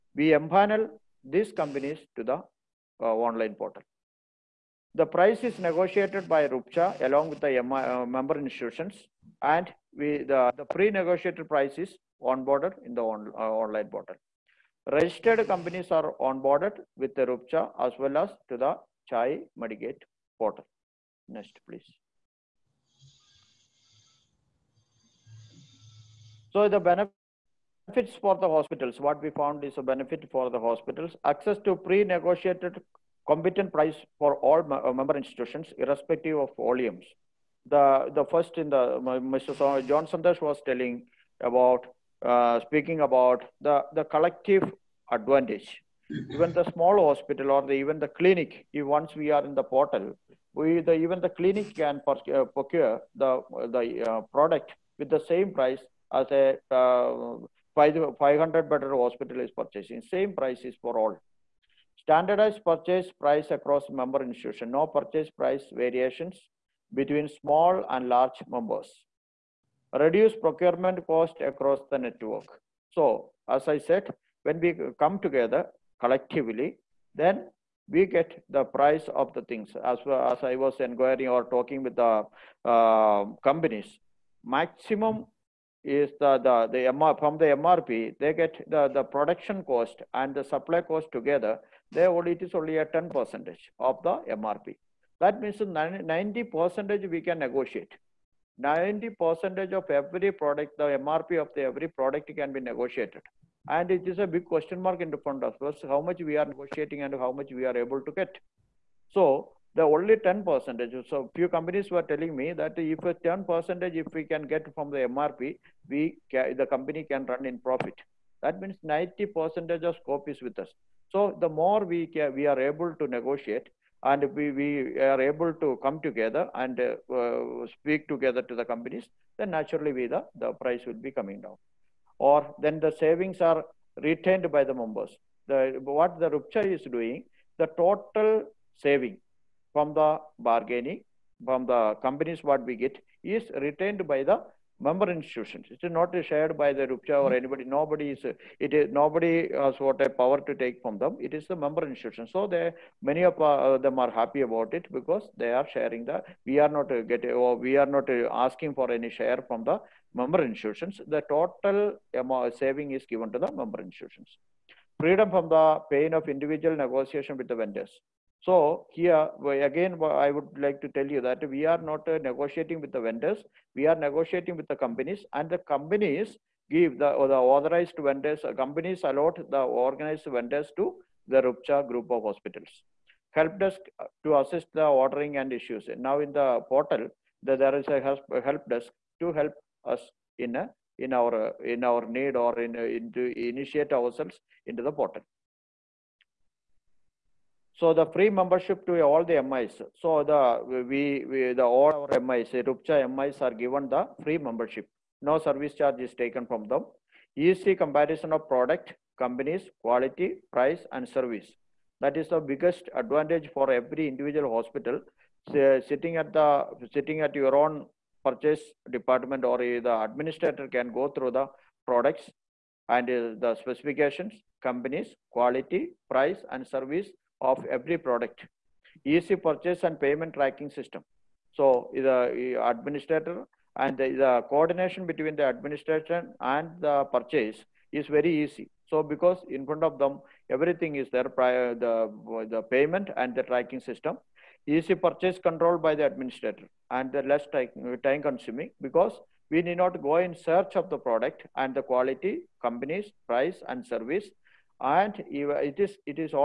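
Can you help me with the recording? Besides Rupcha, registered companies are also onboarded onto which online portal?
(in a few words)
Chai Medigate.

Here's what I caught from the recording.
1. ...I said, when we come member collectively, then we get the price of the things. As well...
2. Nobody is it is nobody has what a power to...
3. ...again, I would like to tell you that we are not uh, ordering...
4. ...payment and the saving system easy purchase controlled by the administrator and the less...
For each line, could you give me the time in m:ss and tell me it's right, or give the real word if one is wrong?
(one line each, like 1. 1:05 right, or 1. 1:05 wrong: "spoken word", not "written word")
1. 1:13 wrong: "together", not "member"
2. 2:27 right
3. 2:49 wrong: "negotiating", not "ordering"
4. 4:02 wrong: "tracking", not "saving".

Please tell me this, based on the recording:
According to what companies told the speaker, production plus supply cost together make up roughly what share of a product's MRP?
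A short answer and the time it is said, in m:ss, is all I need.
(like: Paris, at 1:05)
10%, at 1:32.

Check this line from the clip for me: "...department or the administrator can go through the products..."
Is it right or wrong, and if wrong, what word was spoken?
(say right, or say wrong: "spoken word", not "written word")
right.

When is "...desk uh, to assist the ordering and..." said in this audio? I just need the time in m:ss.
3:03.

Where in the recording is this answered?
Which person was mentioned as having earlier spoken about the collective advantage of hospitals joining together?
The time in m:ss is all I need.
0:39.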